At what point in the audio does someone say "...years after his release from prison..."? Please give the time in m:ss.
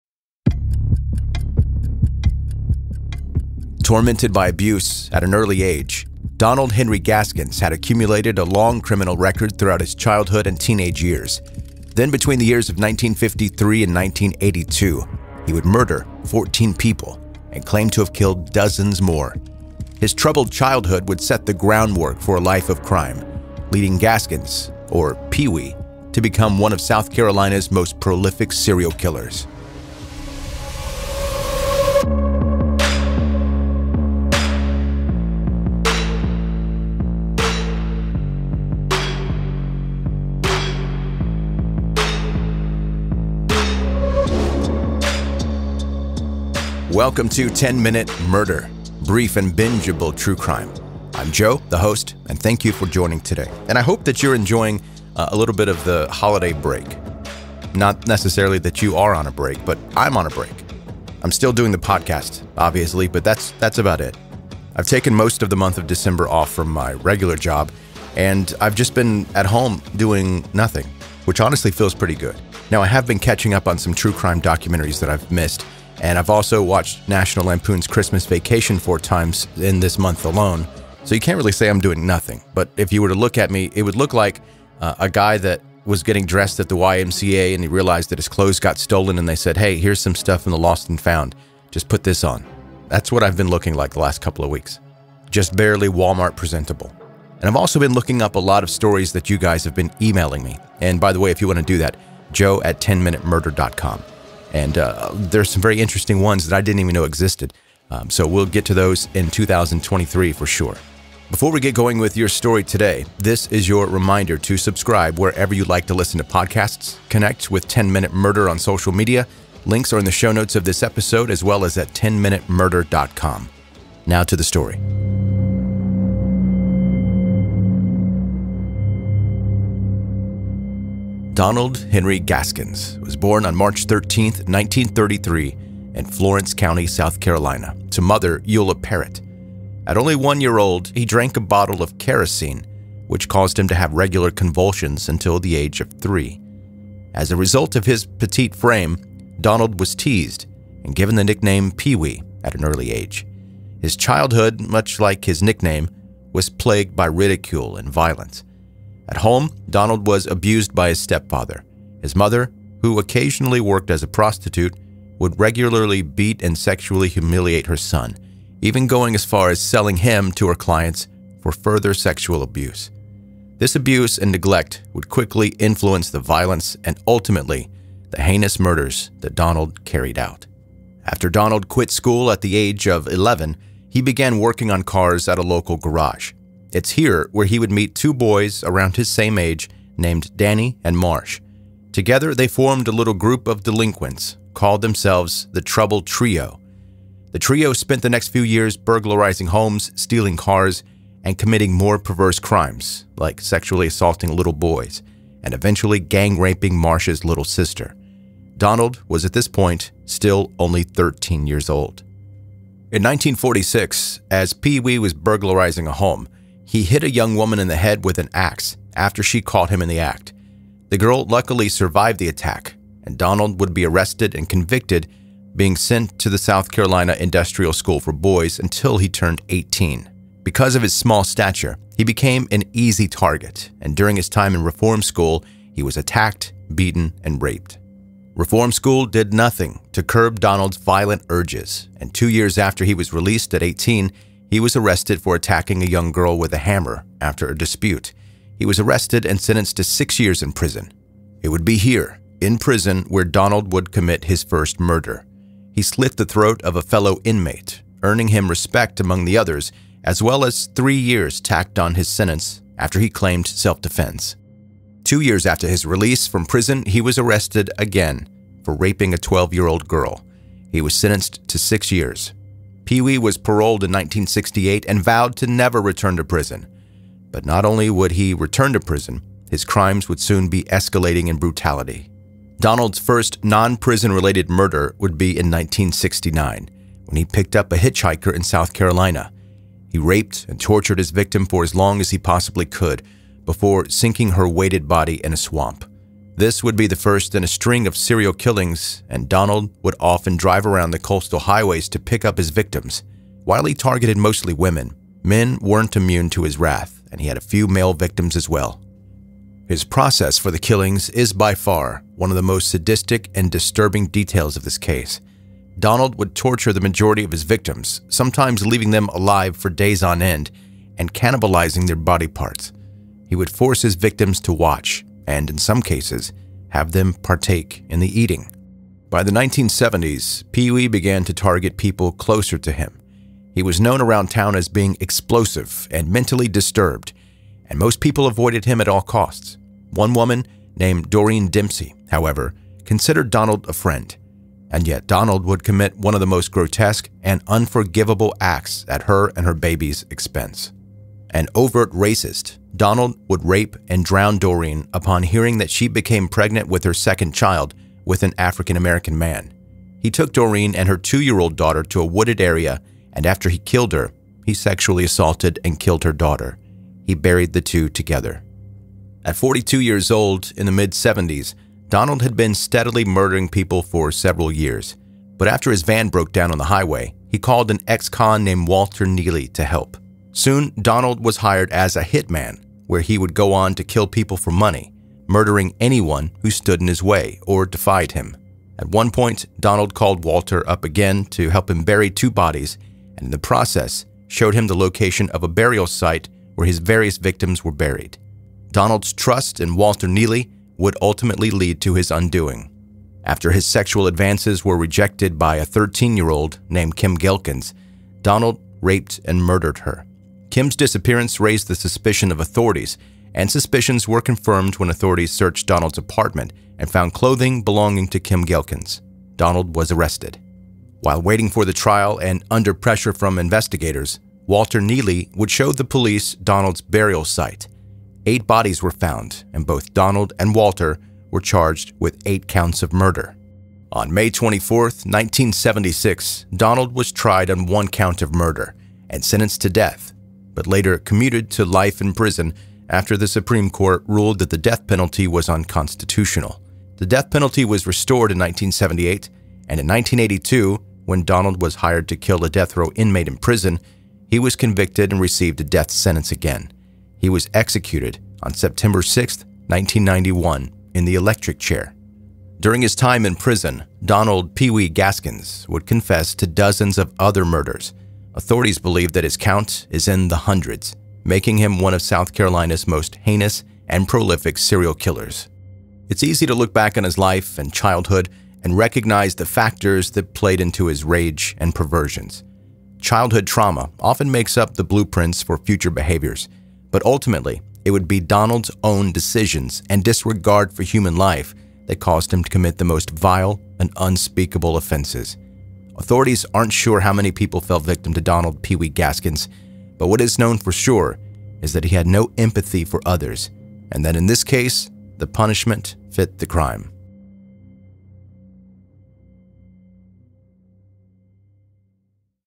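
4:25.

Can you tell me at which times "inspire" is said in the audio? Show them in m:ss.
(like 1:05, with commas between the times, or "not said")
not said.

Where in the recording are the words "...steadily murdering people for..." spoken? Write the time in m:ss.
6:12.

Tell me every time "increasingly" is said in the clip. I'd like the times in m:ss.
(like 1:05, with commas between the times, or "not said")
not said.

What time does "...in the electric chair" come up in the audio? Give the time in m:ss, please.
7:40.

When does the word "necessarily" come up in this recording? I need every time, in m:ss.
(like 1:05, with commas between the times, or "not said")
0:58.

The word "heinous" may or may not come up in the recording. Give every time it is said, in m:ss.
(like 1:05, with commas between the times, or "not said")
2:58, 7:53.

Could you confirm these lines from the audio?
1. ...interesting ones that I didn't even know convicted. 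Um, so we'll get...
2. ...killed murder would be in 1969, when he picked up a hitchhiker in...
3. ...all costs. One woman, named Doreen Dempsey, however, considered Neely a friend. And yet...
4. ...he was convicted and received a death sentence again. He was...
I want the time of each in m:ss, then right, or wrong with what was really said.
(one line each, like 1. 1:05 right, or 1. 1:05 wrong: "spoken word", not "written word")
1. 1:45 wrong: "existed", not "convicted"
2. 4:44 wrong: "related", not "killed"
3. 5:38 wrong: "Donald", not "Neely"
4. 7:34 right.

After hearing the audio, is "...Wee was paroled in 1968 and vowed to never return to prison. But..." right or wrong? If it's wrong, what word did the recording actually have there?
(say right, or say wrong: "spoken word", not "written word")
right.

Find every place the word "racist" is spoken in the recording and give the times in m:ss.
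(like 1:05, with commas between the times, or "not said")
5:51.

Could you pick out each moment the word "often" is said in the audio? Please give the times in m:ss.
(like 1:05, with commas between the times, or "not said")
4:59, 8:03.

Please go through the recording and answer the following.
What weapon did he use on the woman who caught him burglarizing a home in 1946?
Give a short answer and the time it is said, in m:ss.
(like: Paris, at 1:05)
axe, at 3:38.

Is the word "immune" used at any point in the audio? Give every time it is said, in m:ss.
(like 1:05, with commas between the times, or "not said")
5:05.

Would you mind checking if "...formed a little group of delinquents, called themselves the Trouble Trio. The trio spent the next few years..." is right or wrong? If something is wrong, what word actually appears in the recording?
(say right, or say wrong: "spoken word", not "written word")
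right.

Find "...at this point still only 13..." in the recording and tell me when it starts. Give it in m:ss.
3:29.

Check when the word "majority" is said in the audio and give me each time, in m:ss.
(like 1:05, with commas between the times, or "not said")
5:16.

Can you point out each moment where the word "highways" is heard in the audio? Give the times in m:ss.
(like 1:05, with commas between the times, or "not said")
5:01, 6:16.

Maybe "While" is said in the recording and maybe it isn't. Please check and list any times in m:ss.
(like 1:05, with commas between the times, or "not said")
5:03, 7:01.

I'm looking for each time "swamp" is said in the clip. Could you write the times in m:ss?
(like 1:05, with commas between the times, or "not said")
4:55.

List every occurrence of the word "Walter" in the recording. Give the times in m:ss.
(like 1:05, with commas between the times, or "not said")
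6:18, 6:30, 6:39, 7:04, 7:10.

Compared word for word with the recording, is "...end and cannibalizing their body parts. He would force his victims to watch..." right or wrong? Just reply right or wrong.
right.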